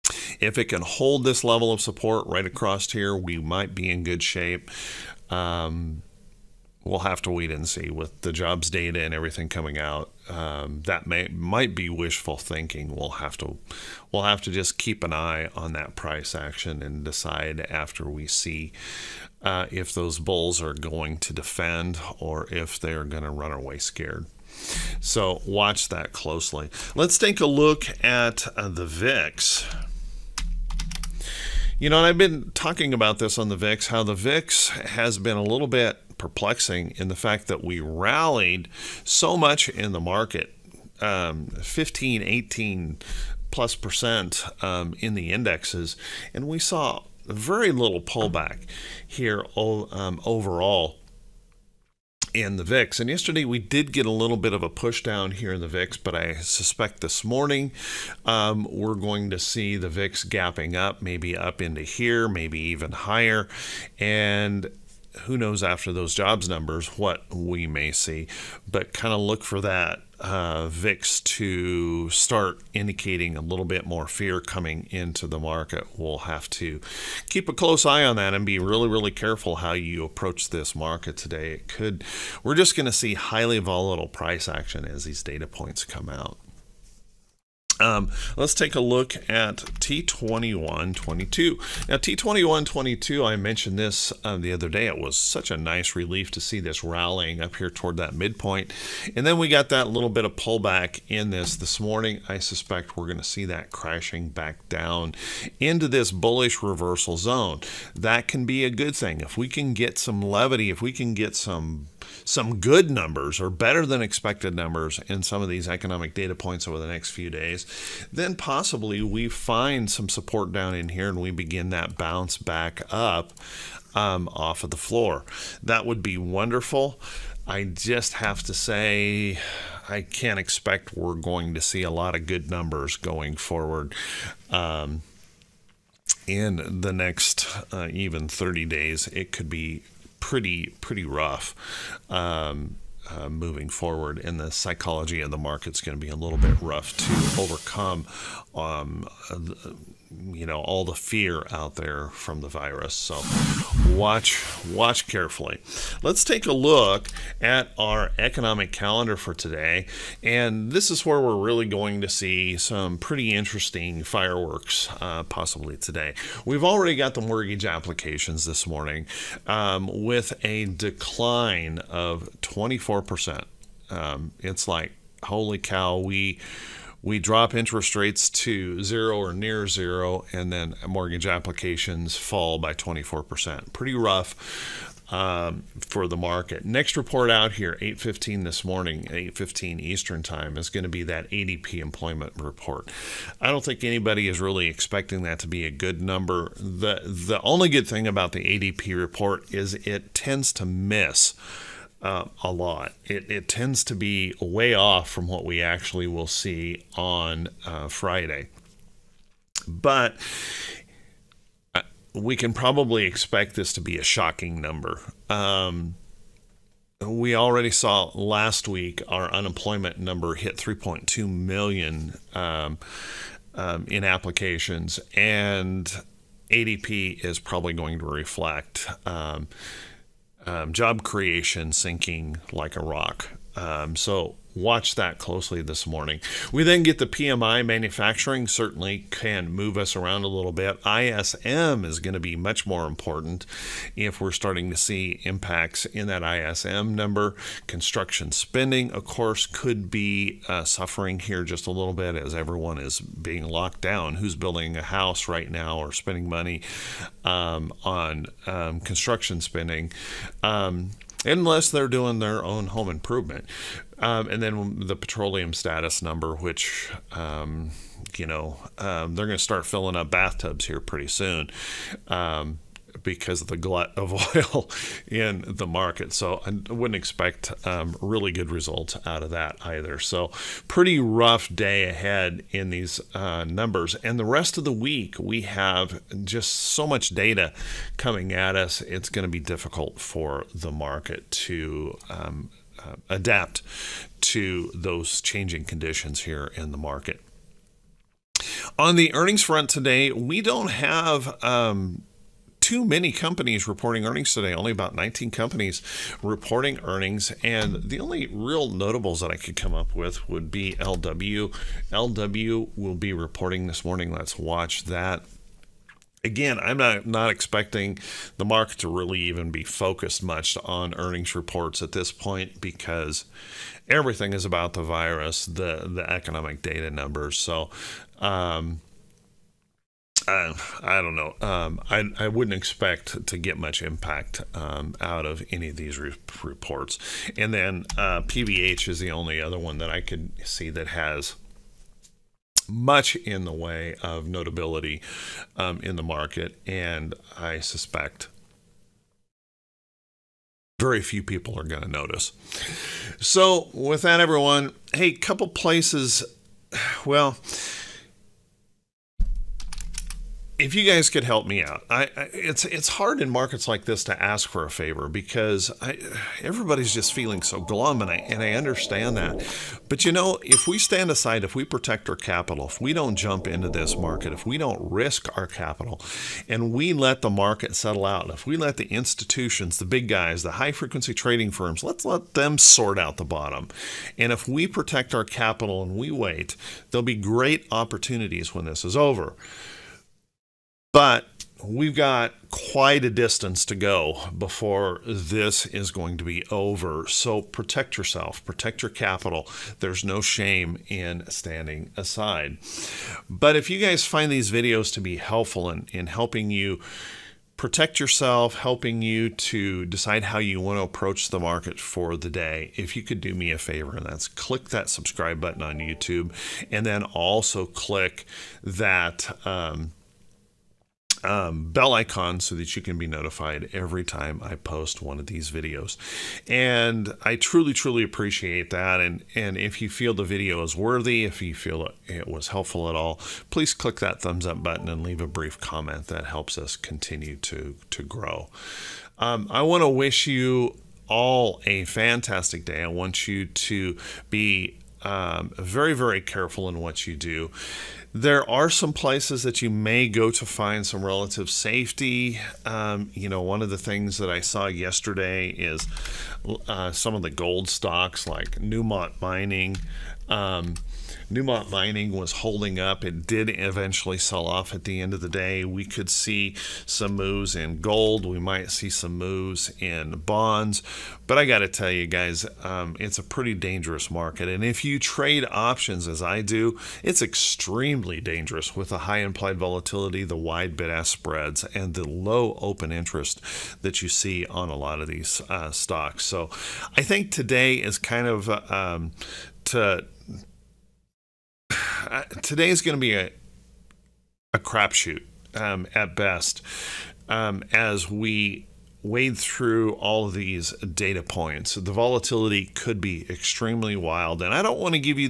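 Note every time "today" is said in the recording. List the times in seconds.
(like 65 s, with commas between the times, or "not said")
81 s, 159 s, 165 s, 299 s, 304 s, 487 s, 492 s.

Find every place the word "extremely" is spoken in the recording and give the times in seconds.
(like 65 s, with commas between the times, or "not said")
477 s, 503 s.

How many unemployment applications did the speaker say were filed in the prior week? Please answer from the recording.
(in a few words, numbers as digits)
3.2 million.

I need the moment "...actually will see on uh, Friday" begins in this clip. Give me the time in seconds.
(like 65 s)
205 s.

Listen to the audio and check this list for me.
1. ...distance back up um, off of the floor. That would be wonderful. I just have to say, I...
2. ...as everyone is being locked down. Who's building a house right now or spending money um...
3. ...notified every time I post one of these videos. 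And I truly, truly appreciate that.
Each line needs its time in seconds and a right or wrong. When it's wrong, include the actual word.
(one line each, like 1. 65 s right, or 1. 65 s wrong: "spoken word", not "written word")
1. 121 s wrong: "bounce", not "distance"
2. 252 s right
3. 423 s right.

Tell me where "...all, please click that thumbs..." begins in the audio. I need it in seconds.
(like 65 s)
432 s.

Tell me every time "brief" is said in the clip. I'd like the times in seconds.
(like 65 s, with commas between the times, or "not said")
435 s.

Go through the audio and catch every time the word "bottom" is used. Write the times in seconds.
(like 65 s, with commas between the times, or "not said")
383 s.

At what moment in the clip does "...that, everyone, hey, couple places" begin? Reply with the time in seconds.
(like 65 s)
354 s.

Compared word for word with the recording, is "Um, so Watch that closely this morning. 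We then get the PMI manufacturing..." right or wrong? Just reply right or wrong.
right.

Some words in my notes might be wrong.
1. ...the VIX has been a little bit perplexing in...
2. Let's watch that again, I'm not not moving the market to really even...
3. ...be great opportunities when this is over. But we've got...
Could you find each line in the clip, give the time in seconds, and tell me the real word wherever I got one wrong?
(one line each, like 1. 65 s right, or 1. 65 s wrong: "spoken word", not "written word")
1. 34 s right
2. 314 s wrong: "expecting", not "moving"
3. 387 s right.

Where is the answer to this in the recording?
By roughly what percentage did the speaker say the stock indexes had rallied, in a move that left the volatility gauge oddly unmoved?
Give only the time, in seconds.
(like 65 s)
41 s.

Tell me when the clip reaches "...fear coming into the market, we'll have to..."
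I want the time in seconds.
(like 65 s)
74 s.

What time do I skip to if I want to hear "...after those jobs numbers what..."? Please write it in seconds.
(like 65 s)
65 s.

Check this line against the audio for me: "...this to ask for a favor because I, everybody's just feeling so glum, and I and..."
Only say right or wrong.
right.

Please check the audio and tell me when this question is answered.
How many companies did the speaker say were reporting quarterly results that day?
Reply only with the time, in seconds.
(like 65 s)
304 s.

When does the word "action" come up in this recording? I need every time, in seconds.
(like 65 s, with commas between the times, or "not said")
16 s, 84 s.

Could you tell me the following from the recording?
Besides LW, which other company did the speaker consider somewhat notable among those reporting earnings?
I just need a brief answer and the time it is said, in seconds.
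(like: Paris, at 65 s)
PVH, at 338 s.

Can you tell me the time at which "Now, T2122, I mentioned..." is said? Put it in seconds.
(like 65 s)
91 s.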